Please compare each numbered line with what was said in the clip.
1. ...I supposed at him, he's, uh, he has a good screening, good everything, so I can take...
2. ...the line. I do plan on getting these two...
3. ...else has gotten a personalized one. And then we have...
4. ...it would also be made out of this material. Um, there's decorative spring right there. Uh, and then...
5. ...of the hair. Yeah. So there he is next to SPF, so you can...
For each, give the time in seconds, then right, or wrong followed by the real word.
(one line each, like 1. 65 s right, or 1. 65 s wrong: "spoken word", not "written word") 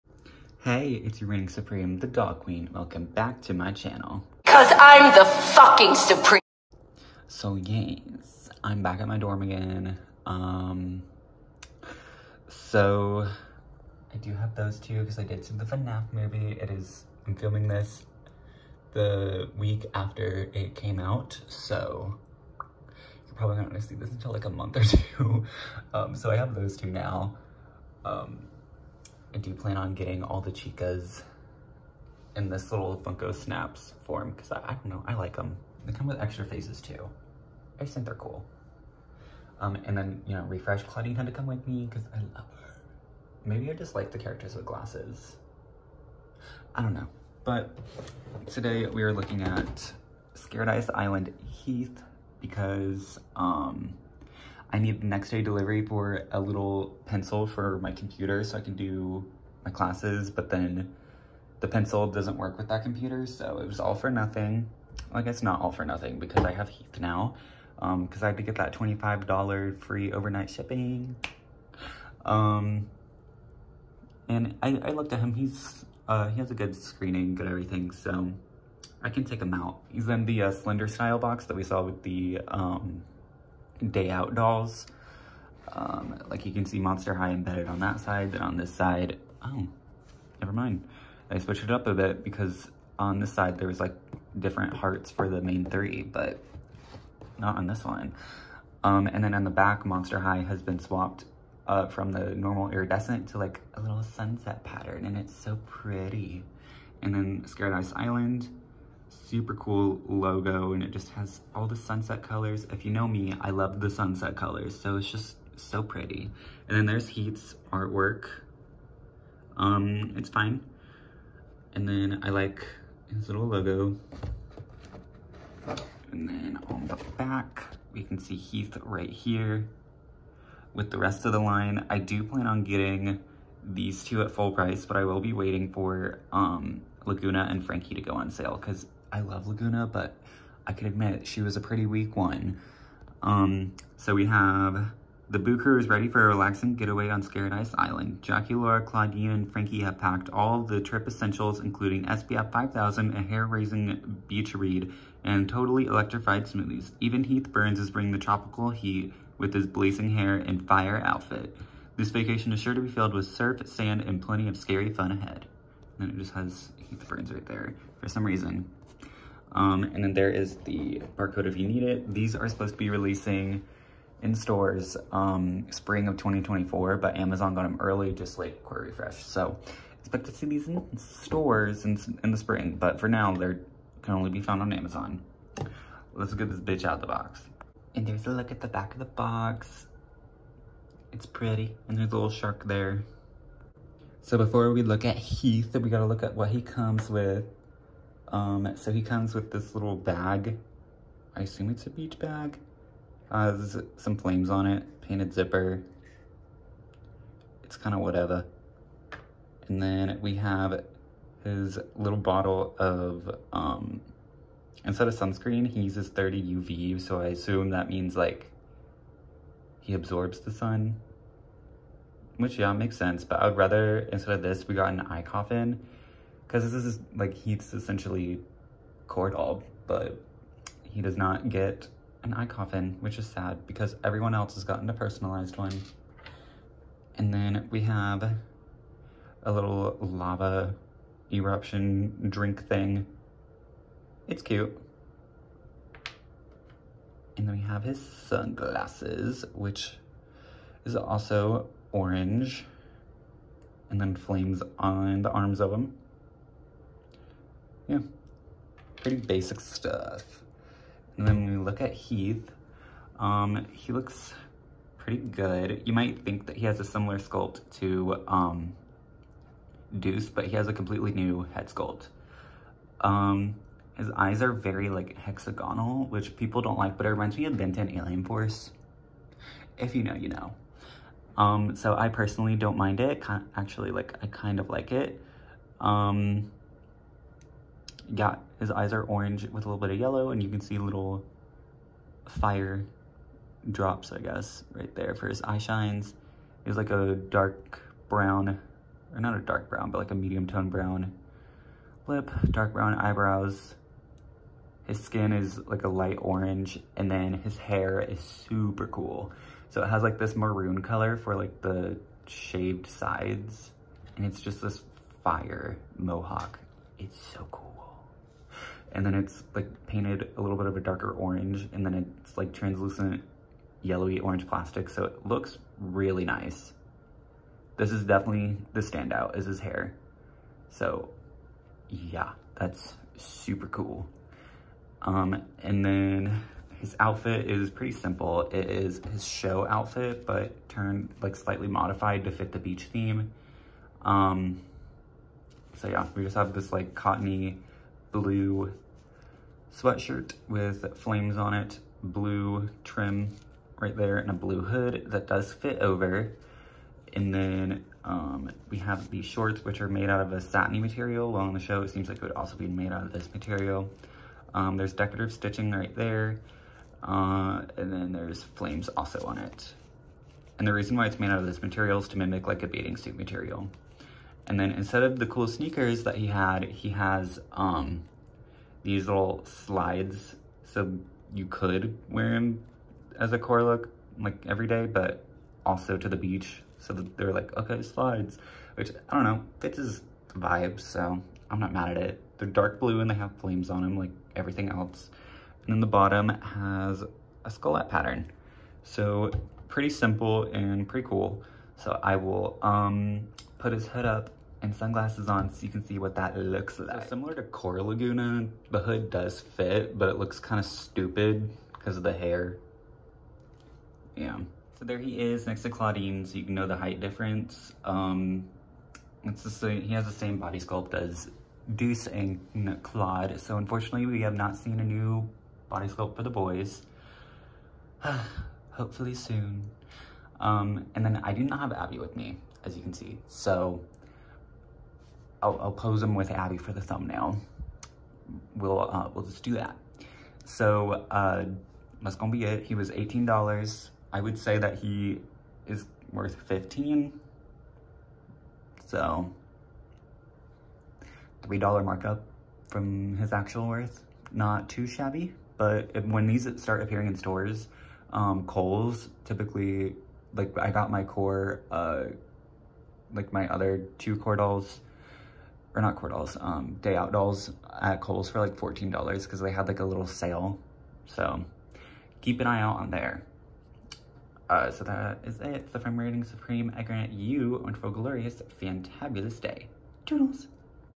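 1. 74 s wrong: "looked", not "supposed"
2. 131 s right
3. 234 s right
4. 362 s wrong: "stitching", not "spring"
5. 411 s wrong: "Clawdeen", not "SPF".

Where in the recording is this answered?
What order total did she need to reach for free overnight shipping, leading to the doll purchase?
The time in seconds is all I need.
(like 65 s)
68 s.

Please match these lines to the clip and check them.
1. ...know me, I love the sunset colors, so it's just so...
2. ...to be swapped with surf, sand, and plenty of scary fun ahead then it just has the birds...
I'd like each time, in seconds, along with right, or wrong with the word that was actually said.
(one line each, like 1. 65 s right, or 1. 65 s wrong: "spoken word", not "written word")
1. 112 s right
2. 162 s wrong: "filled", not "swapped".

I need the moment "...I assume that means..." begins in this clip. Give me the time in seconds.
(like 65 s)
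217 s.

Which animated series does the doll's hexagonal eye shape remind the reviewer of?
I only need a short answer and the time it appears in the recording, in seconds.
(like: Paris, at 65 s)
Ben 10 Alien Force, at 277 s.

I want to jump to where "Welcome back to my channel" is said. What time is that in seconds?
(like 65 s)
2 s.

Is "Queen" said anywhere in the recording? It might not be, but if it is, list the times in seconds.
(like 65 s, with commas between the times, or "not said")
2 s.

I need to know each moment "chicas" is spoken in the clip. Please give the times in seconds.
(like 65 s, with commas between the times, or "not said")
30 s.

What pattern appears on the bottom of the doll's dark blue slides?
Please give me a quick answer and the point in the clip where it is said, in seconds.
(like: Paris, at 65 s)
Skullet pattern, at 397 s.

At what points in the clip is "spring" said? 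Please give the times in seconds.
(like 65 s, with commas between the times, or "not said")
175 s, 182 s.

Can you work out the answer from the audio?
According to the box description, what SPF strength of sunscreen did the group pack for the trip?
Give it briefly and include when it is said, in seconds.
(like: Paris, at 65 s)
SPF 5000, at 152 s.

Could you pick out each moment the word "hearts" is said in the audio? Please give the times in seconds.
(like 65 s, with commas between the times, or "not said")
94 s.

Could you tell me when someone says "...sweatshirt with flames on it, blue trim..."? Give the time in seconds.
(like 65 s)
349 s.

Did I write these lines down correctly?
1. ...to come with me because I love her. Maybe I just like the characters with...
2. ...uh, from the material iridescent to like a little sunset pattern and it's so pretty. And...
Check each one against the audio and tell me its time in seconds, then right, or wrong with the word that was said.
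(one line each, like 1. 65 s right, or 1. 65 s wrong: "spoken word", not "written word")
1. 41 s right
2. 101 s wrong: "normal", not "material".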